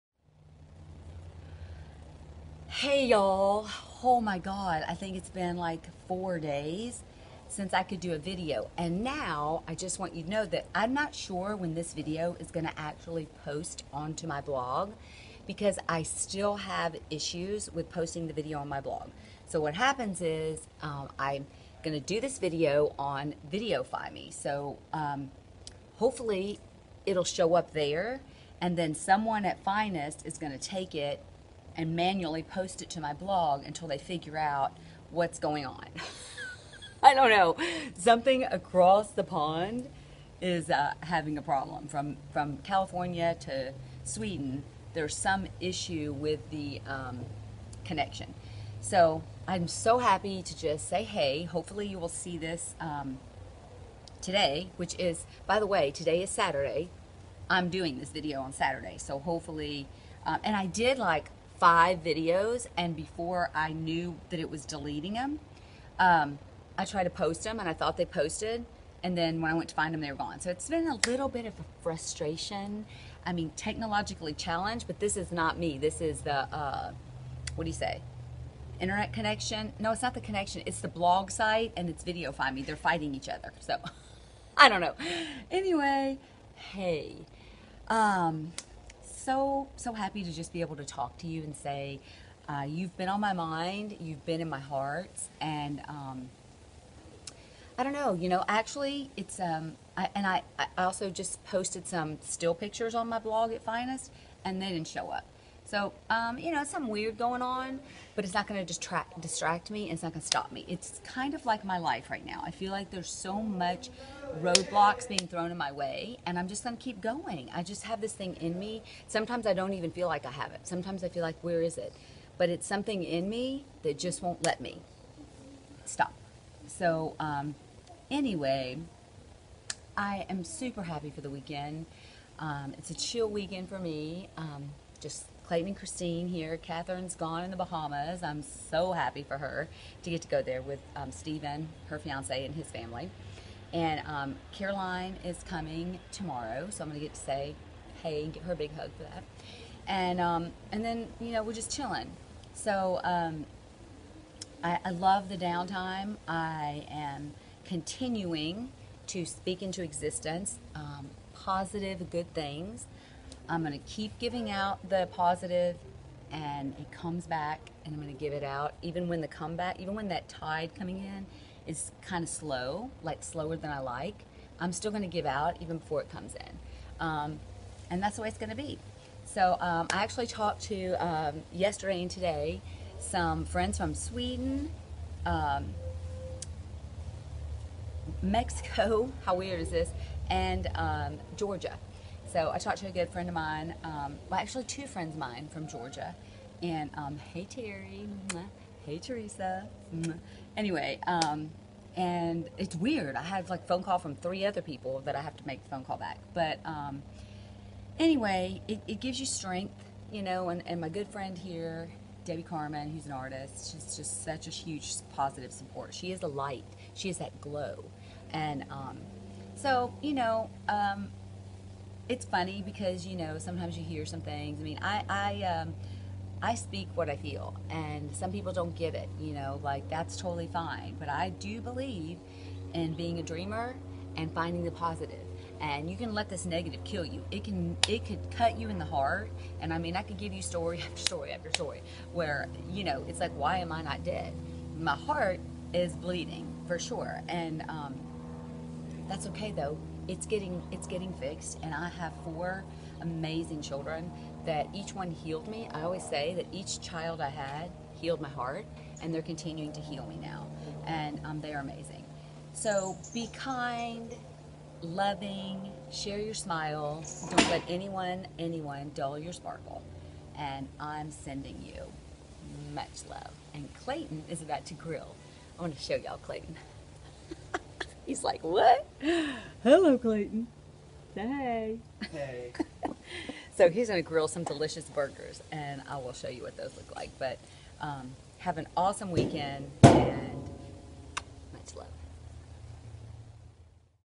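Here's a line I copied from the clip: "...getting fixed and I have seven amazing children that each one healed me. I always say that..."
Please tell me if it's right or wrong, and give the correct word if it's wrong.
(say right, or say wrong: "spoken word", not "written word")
wrong: "four", not "seven".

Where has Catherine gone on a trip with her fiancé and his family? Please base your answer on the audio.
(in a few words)
the Bahamas.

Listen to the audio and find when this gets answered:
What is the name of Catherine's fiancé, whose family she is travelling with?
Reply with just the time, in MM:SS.
02:21.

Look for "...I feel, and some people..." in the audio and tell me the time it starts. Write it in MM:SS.
03:47.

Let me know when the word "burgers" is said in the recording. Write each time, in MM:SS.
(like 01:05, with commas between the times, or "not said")
04:44.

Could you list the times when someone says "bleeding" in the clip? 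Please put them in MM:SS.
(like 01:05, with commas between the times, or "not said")
04:05.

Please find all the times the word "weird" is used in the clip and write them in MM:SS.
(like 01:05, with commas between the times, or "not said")
01:46, 03:09, 03:22.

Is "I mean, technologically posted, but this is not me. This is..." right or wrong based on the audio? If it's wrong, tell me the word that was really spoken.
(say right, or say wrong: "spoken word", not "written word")
wrong: "challenged", not "posted".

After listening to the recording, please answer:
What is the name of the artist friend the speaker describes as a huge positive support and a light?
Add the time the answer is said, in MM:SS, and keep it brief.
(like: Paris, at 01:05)
Debbie Carmen, at 03:32.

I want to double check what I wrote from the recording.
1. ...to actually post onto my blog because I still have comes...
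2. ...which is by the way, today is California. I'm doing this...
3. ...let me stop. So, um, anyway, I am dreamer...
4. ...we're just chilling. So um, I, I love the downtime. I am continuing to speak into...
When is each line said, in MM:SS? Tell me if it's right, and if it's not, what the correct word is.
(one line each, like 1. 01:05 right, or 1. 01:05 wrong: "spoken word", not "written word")
1. 00:12 wrong: "issues", not "comes"
2. 00:54 wrong: "Saturday", not "California"
3. 02:04 wrong: "super", not "dreamer"
4. 02:31 right.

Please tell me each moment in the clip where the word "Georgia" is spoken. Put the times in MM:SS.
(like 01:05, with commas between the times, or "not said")
03:11, 03:15.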